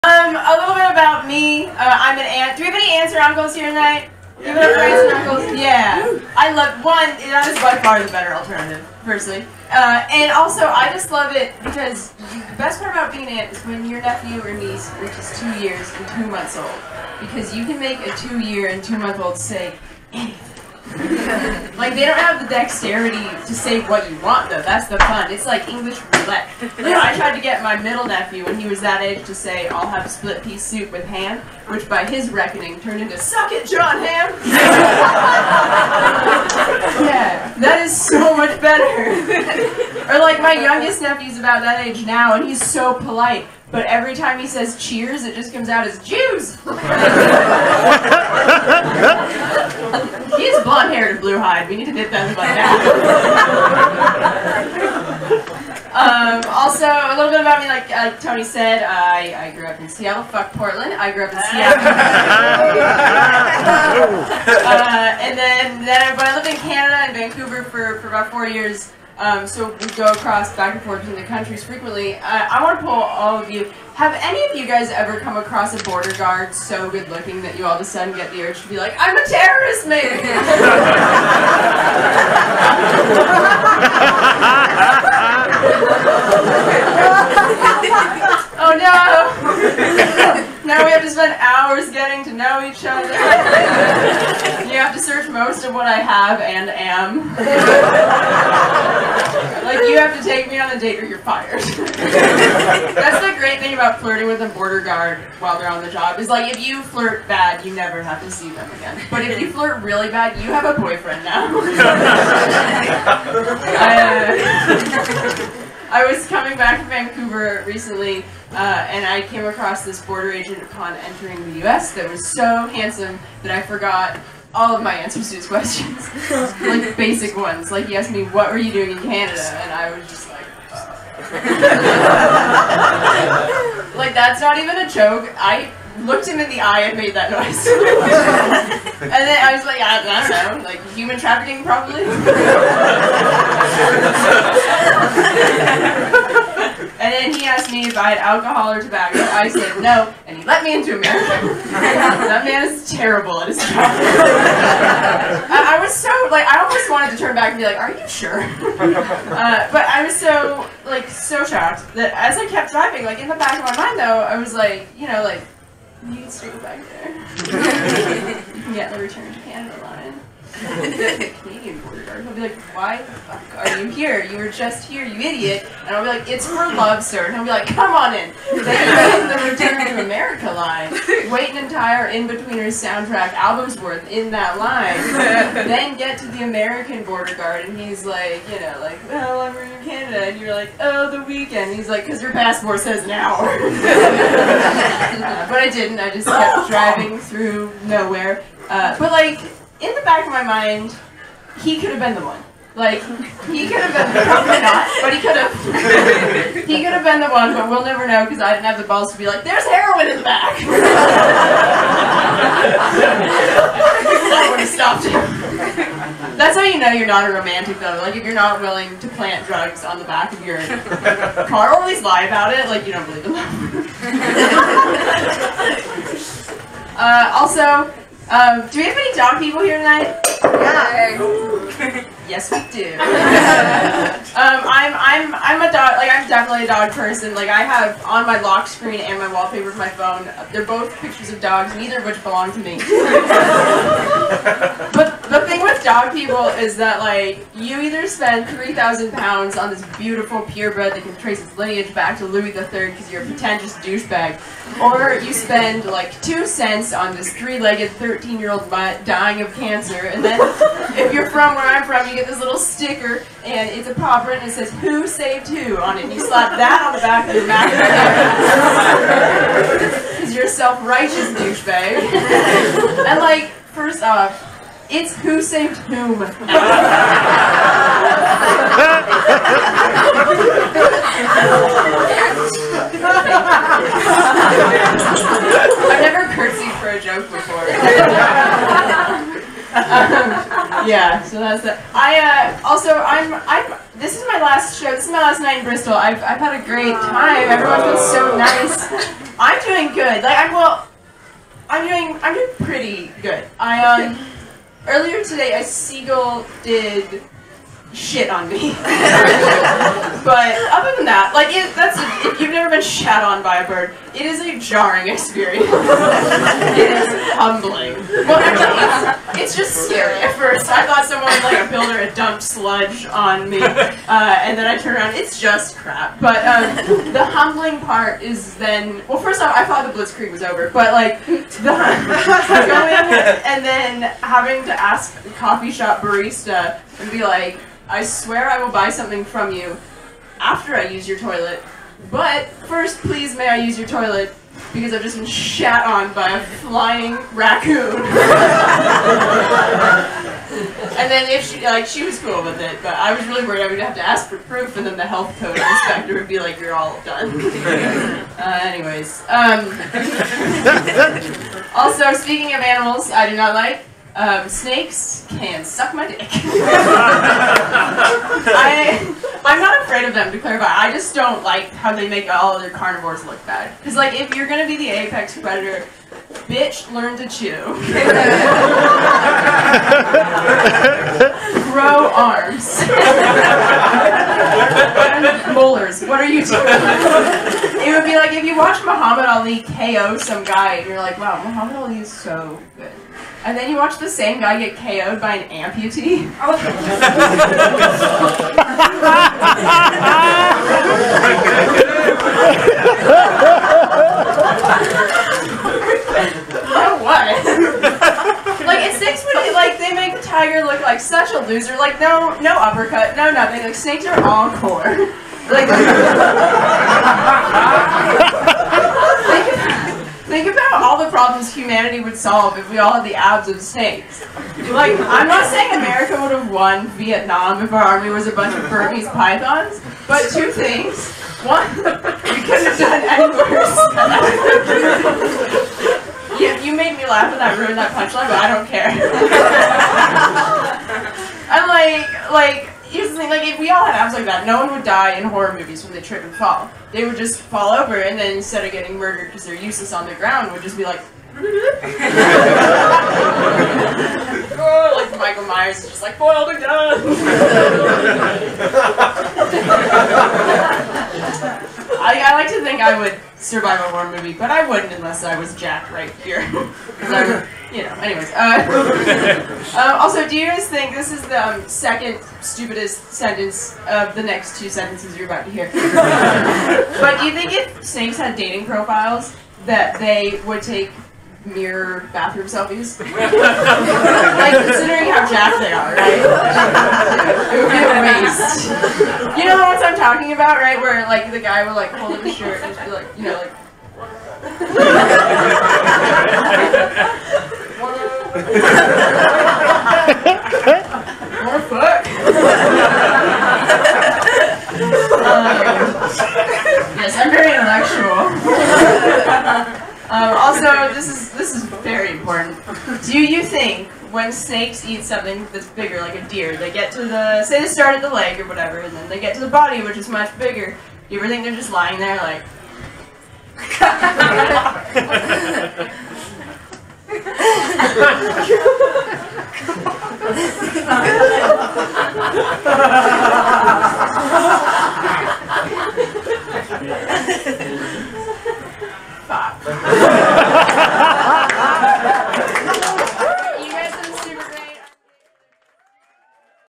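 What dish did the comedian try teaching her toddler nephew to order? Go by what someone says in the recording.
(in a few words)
Split pea soup with ham.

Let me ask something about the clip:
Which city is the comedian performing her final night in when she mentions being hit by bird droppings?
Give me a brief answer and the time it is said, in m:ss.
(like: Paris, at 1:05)
Bristol, at 4:55.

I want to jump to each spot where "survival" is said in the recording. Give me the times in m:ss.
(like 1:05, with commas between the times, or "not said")
7:43.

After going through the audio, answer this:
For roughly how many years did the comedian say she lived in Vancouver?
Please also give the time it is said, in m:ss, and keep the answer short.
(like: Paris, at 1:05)
4, at 1:08.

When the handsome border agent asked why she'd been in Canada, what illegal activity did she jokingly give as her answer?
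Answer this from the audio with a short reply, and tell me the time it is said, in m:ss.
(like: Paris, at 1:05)
Human trafficking, at 2:20.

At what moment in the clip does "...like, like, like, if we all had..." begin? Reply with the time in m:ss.
7:21.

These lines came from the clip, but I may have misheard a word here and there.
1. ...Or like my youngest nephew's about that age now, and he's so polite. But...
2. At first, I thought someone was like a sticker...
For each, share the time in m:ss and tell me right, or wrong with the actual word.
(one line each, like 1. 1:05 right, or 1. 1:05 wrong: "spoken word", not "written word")
1. 0:40 right
2. 5:20 wrong: "builder", not "sticker".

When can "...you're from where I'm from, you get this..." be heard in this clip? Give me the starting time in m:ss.
4:21.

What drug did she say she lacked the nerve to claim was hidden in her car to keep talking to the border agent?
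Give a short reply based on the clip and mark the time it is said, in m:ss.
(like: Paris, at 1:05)
Heroin, at 3:29.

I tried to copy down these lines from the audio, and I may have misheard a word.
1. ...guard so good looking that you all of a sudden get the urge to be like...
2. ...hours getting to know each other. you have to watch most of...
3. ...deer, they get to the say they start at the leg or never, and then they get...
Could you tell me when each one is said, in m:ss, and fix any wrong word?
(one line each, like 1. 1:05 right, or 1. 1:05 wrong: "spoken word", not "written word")
1. 1:16 right
2. 1:31 wrong: "search", not "watch"
3. 8:36 wrong: "whatever", not "never".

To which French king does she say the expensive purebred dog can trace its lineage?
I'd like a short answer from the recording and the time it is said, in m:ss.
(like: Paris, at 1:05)
Louis III, at 4:12.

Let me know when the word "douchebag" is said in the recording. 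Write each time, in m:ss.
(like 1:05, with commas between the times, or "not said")
4:13, 4:31.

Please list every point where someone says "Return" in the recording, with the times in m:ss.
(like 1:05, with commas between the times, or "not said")
2:48, 2:59.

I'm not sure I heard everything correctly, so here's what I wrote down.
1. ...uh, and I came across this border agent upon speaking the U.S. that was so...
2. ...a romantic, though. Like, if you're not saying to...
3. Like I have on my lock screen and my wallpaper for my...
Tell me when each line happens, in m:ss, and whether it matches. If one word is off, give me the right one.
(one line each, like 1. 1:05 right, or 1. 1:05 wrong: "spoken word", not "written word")
1. 1:58 wrong: "entering", not "speaking"
2. 3:37 wrong: "willing", not "saying"
3. 3:57 right.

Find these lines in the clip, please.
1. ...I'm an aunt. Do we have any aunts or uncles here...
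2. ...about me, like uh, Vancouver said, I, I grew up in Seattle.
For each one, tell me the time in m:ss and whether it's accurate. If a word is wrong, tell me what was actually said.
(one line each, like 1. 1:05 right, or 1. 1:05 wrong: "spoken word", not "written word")
1. 0:02 right
2. 0:57 wrong: "Tony", not "Vancouver".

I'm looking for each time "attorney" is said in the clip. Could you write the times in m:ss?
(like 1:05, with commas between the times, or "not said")
not said.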